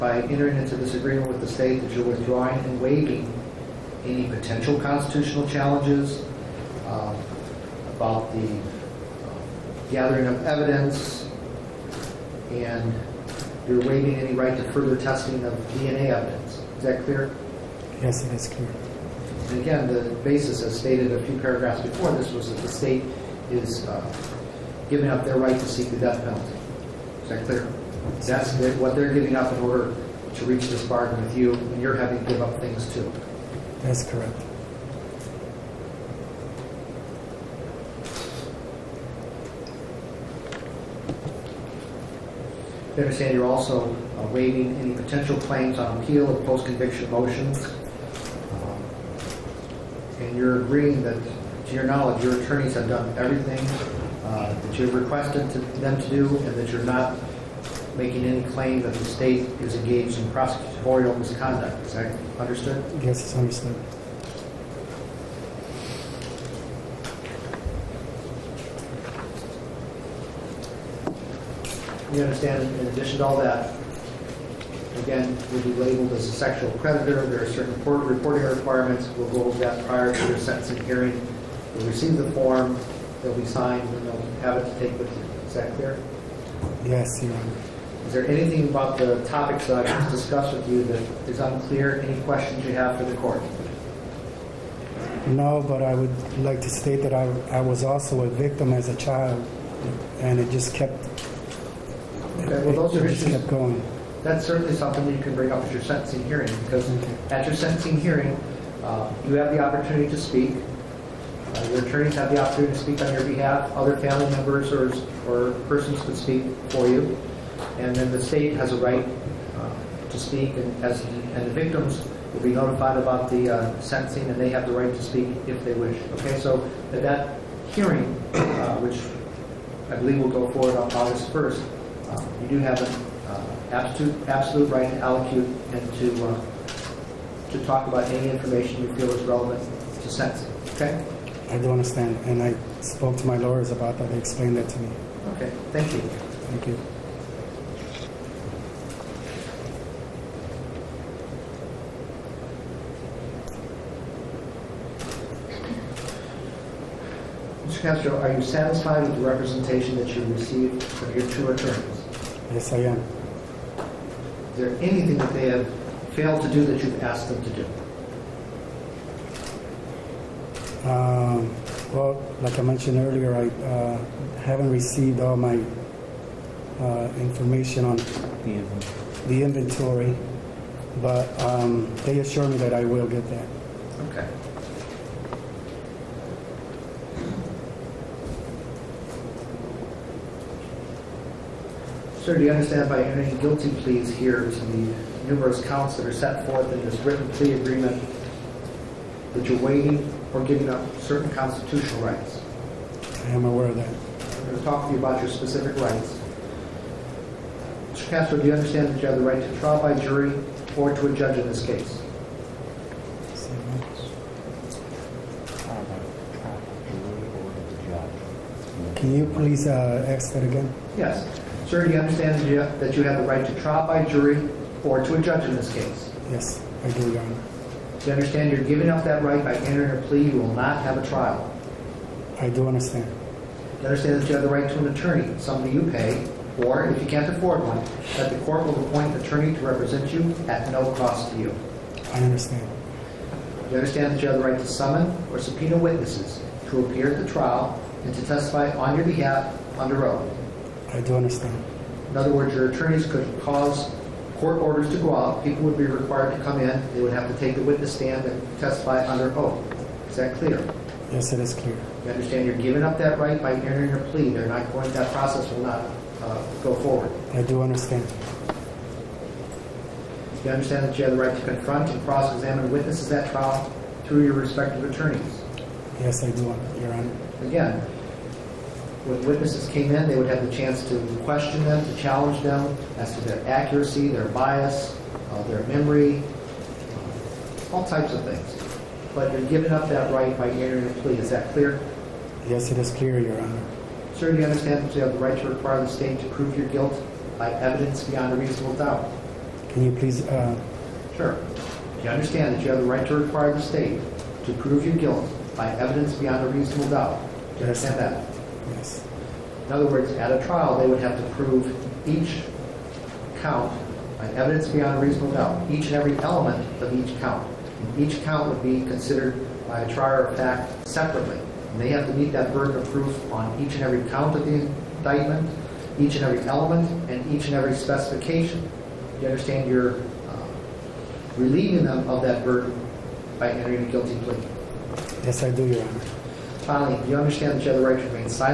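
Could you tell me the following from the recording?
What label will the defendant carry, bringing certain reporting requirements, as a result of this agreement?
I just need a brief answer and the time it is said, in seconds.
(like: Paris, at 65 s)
sexual predator, at 76 s.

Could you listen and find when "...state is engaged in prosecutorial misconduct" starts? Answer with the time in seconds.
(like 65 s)
59 s.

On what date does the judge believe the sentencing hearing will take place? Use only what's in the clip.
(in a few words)
August 1st.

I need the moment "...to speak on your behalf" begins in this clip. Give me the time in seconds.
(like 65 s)
112 s.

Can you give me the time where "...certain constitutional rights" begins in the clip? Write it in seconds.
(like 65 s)
200 s.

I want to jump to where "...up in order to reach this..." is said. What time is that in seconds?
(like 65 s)
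29 s.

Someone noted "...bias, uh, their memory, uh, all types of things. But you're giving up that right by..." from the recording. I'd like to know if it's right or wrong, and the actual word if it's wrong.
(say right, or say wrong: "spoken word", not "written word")
right.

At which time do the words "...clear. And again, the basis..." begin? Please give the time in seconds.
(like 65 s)
18 s.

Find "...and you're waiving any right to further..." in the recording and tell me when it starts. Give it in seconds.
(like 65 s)
12 s.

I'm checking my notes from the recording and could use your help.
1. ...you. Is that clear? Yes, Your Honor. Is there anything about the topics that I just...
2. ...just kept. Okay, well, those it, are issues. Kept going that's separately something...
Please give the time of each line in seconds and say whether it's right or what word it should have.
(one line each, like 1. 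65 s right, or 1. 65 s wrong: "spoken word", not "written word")
1. 85 s right
2. 100 s wrong: "certainly", not "separately".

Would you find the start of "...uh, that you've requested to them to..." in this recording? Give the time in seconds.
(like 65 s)
54 s.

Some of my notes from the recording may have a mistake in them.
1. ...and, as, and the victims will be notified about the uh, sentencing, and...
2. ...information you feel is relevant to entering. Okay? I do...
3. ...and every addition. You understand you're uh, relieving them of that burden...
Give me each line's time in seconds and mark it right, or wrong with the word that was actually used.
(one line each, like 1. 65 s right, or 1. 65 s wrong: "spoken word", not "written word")
1. 120 s right
2. 138 s wrong: "sentencing", not "entering"
3. 327 s wrong: "specification", not "addition".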